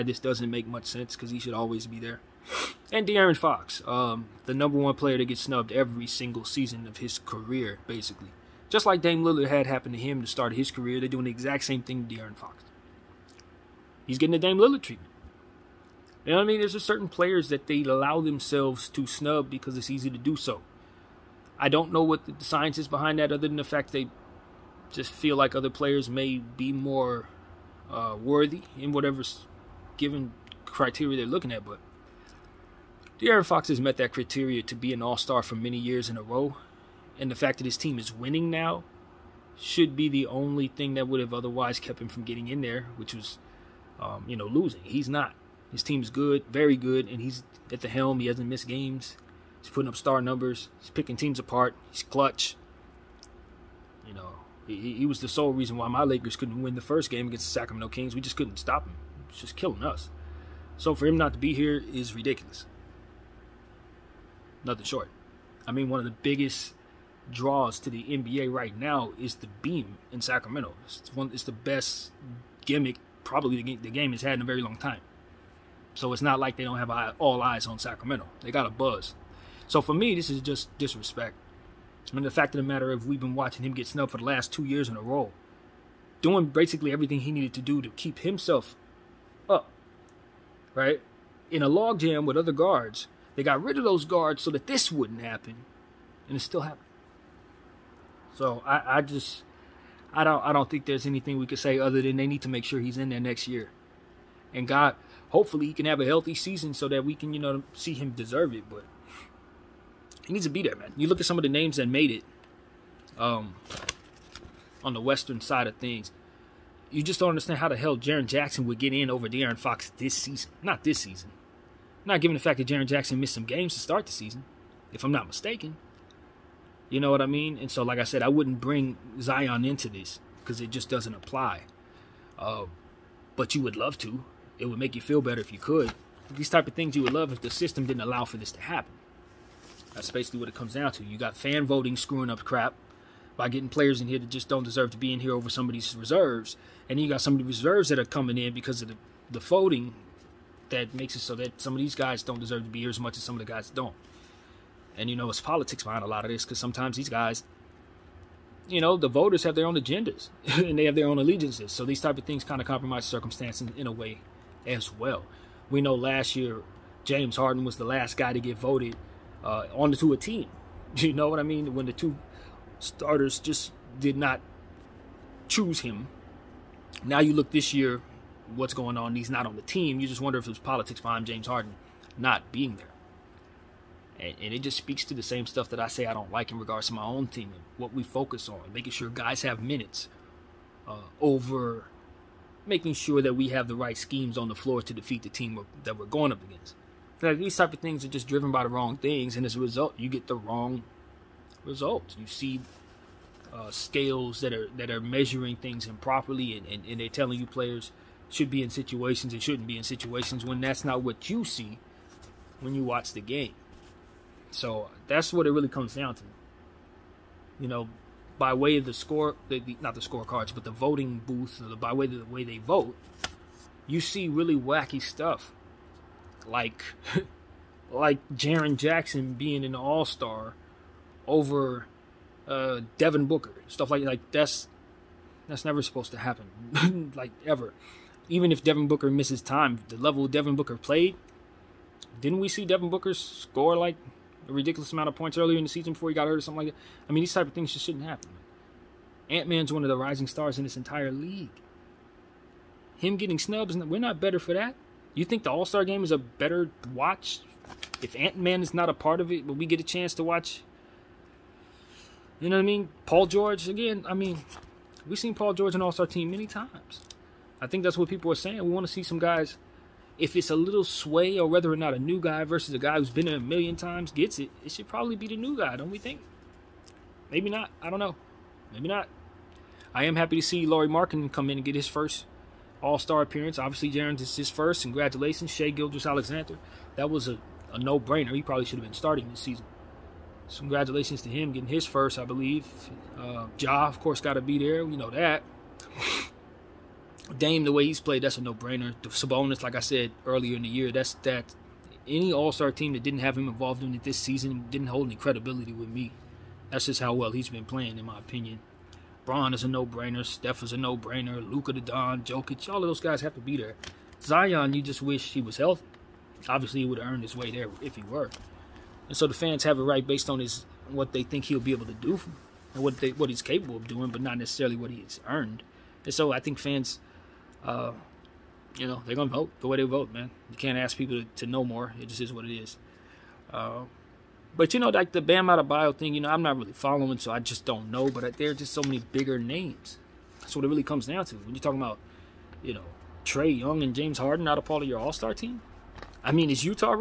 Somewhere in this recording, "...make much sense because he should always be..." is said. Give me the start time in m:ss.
0:00.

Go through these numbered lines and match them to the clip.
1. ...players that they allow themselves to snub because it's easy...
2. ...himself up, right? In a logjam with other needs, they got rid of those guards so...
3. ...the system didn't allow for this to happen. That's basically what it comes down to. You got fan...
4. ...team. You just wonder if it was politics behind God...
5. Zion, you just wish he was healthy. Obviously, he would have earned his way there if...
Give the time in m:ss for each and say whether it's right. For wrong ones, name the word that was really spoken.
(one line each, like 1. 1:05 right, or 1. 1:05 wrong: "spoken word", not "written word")
1. 0:17 right
2. 1:28 wrong: "guards", not "needs"
3. 2:17 right
4. 2:59 wrong: "James", not "God"
5. 5:14 right.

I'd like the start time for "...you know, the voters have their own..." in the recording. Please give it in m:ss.
2:38.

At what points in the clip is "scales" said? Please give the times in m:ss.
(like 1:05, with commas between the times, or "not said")
3:23.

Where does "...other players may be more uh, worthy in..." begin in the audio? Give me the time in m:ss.
0:25.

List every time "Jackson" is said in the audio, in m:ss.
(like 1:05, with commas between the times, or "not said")
1:58, 2:02, 3:48.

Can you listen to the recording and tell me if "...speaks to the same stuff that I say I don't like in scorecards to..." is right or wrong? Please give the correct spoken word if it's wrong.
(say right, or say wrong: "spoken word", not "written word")
wrong: "regards", not "scorecards".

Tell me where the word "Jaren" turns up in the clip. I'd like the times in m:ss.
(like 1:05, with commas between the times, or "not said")
1:57, 2:02, 3:48, 4:43.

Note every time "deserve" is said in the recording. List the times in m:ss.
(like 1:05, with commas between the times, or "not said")
1:48, 2:24, 2:32.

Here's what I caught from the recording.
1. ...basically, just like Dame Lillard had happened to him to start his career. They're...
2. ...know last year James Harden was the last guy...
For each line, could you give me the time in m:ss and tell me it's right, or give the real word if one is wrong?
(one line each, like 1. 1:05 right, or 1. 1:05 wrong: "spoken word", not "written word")
1. 0:07 right
2. 2:45 right.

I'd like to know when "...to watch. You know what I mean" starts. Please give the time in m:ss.
4:20.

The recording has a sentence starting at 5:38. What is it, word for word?
But uh, there are just so many bigger names.